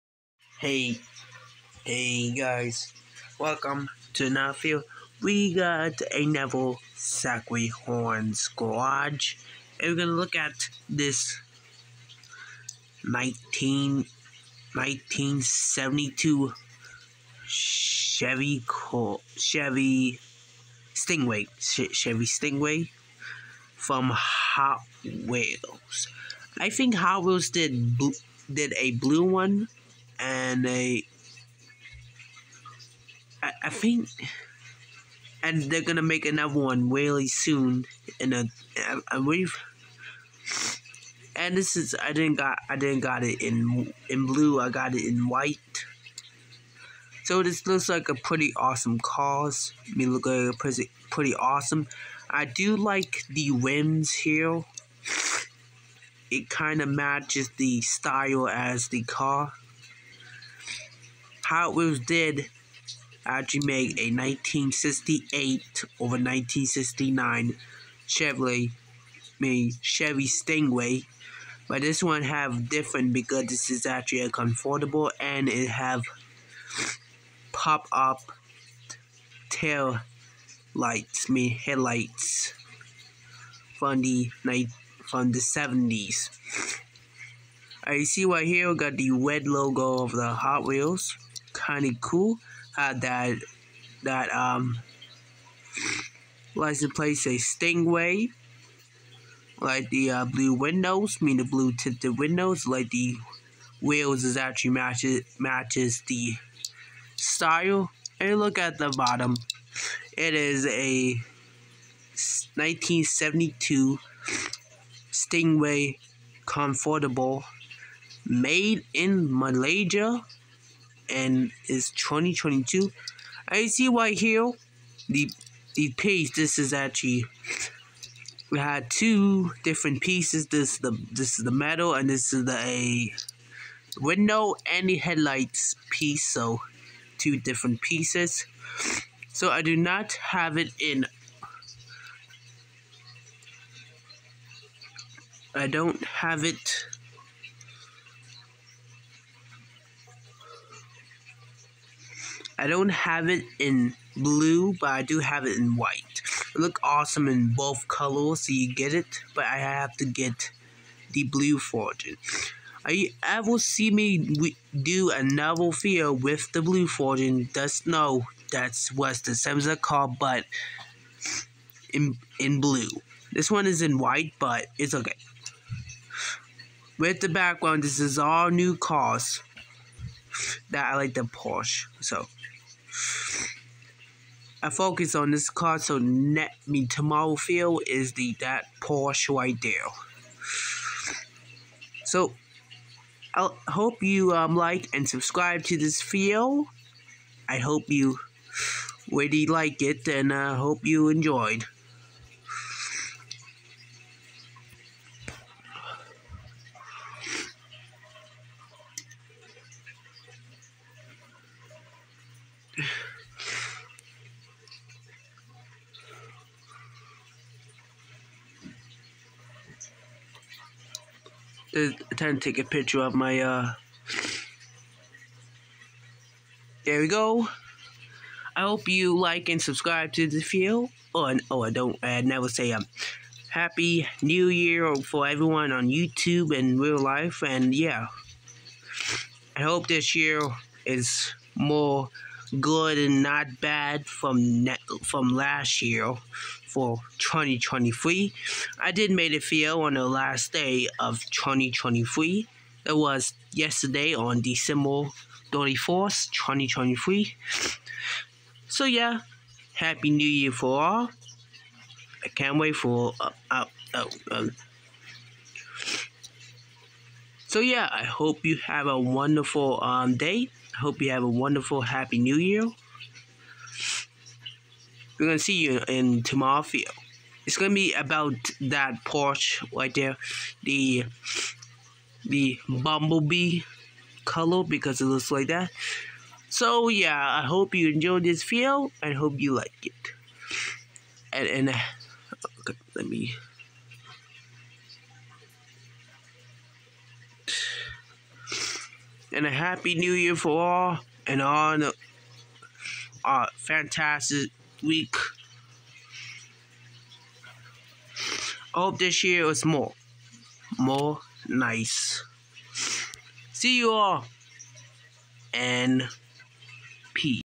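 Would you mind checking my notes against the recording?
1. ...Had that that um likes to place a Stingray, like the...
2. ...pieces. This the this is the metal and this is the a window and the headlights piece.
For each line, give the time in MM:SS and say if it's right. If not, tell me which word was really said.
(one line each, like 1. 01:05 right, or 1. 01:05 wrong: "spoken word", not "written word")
1. 01:32 right
2. 02:10 right.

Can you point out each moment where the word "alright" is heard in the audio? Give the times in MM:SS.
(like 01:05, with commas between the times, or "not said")
not said.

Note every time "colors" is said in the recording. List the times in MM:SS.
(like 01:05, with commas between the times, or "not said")
02:37, 04:44.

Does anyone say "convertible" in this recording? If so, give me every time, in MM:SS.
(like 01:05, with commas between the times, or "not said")
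01:14, 01:56.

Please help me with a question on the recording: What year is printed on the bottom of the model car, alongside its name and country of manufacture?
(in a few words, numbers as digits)
2022.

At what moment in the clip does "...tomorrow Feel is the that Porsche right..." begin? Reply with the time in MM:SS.
03:06.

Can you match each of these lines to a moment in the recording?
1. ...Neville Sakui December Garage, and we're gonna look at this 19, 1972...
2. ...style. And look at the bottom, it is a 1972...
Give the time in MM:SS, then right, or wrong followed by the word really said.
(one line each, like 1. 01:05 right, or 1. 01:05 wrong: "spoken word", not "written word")
1. 00:06 wrong: "Horns", not "December"
2. 01:47 right.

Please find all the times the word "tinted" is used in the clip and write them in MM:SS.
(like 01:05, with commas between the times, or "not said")
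01:41.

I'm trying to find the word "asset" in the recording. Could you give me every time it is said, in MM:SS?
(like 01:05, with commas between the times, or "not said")
not said.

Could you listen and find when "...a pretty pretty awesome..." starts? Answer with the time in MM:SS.
00:50.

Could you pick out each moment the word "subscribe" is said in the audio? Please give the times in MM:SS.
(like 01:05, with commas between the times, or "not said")
03:15, 03:49.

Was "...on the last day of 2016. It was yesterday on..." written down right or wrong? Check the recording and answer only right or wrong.
wrong.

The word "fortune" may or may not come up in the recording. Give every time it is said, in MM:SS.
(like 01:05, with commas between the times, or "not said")
02:41, 02:46.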